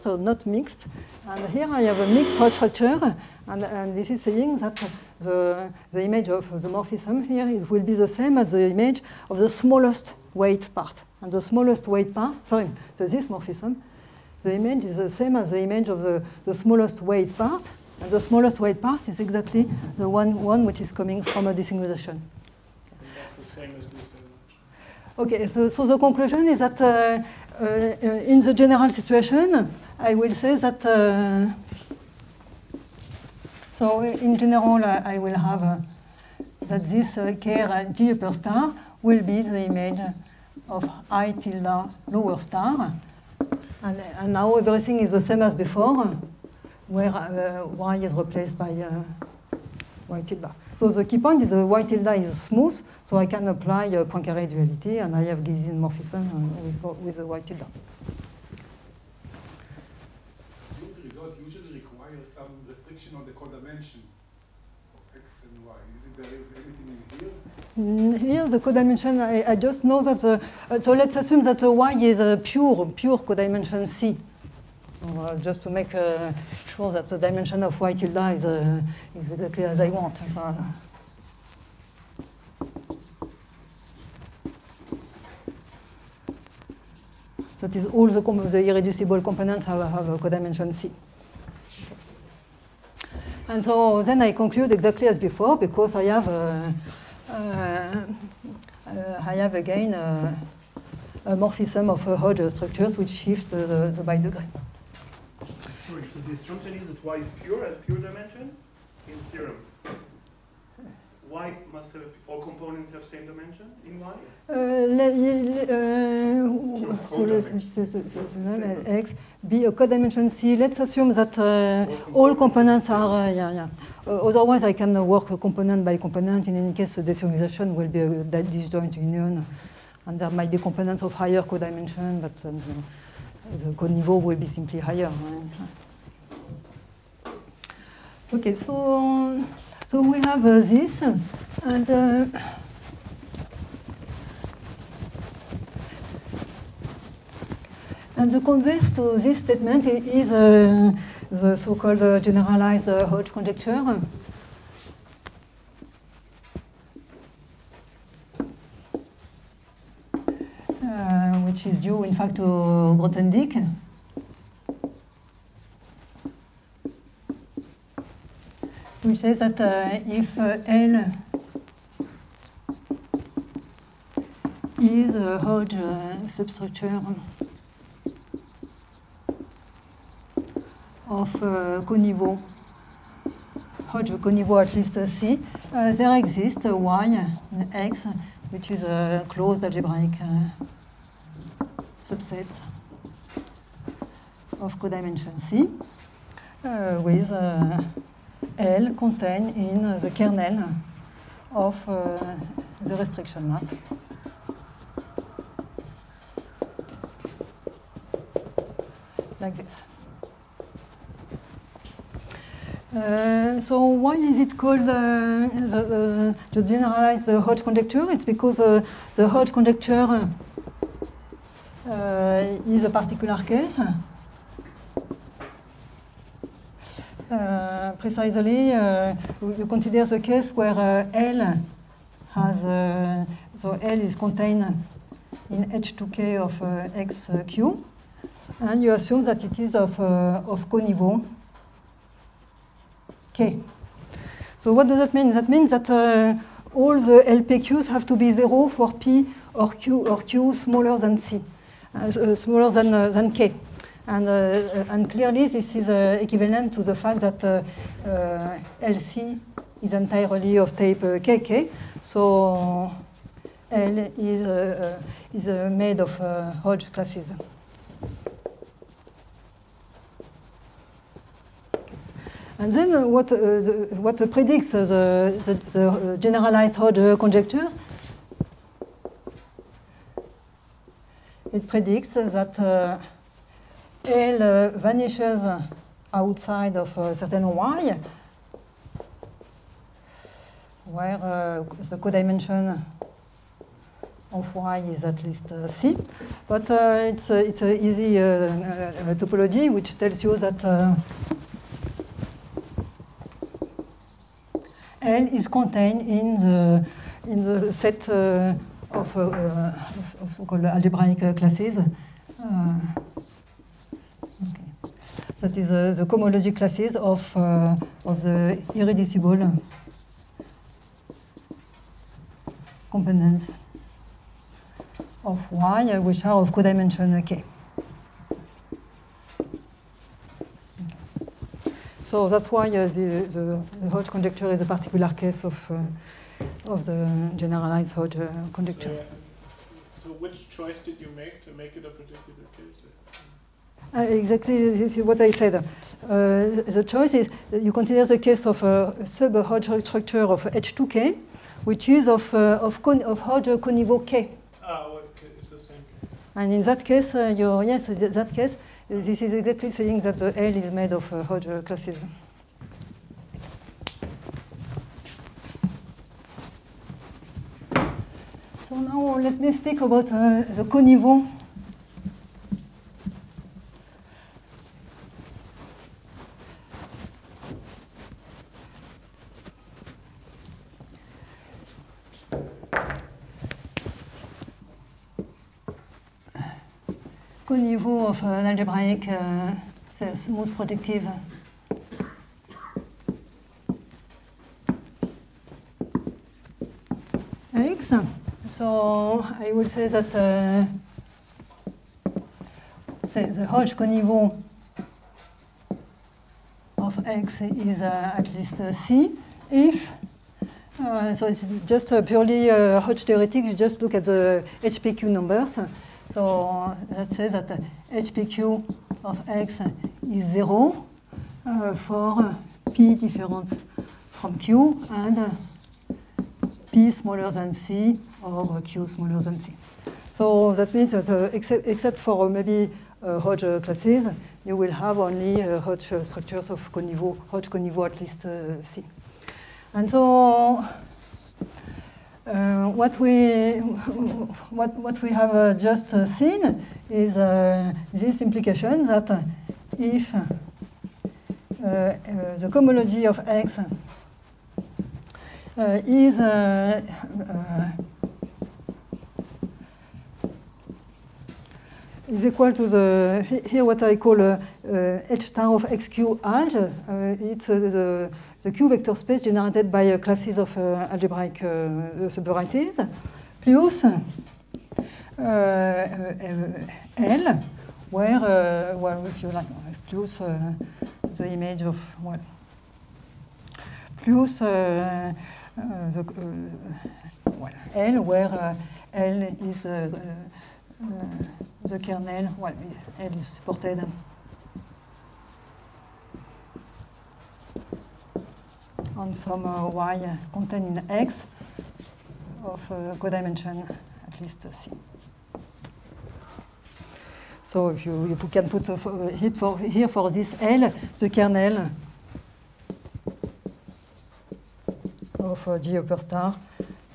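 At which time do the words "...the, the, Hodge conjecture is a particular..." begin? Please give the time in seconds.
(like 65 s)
333 s.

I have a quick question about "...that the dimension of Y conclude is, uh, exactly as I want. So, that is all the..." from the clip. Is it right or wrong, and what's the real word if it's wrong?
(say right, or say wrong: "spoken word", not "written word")
wrong: "tilde", not "conclude".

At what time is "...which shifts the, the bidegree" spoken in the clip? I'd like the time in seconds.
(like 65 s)
102 s.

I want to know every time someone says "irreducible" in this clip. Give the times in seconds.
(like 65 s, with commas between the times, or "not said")
88 s, 318 s.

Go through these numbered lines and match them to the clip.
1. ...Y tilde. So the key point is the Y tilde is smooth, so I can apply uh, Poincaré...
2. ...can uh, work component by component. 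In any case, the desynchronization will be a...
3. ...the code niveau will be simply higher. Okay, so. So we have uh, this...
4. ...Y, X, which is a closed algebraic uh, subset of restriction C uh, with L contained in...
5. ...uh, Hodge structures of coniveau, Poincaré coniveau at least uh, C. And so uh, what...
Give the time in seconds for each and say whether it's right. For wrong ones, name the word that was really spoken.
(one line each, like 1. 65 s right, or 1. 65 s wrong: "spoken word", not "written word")
1. 50 s right
2. 124 s right
3. 133 s right
4. 186 s wrong: "codimension", not "restriction"
5. 435 s wrong: "Hodge", not "Poincaré".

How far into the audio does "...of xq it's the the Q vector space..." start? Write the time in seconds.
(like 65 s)
465 s.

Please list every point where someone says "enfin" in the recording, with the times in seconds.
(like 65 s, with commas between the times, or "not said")
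388 s.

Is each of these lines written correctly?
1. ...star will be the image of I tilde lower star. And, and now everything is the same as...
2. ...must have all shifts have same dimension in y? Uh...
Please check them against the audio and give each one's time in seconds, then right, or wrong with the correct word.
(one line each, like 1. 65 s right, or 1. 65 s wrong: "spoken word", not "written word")
1. 38 s right
2. 111 s wrong: "components", not "shifts".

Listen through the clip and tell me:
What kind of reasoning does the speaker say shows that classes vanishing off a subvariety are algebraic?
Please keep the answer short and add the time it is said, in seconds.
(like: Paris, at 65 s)
easy topology, at 297 s.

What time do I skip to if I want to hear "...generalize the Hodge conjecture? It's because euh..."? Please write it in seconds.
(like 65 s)
216 s.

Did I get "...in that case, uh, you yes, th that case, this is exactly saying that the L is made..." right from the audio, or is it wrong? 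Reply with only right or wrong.
right.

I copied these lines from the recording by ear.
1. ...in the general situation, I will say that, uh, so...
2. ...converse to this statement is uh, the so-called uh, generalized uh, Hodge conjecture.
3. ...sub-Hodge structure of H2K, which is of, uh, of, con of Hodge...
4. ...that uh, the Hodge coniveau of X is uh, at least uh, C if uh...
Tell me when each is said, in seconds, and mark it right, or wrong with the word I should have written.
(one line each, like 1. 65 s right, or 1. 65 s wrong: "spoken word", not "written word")
1. 28 s right
2. 148 s right
3. 349 s right
4. 399 s right.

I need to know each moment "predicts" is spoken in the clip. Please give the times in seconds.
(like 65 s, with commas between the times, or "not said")
274 s, 281 s.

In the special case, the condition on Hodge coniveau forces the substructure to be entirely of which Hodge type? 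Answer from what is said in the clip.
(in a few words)
type KK.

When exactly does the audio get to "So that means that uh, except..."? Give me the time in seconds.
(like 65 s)
430 s.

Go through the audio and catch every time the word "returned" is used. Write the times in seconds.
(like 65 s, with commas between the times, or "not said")
not said.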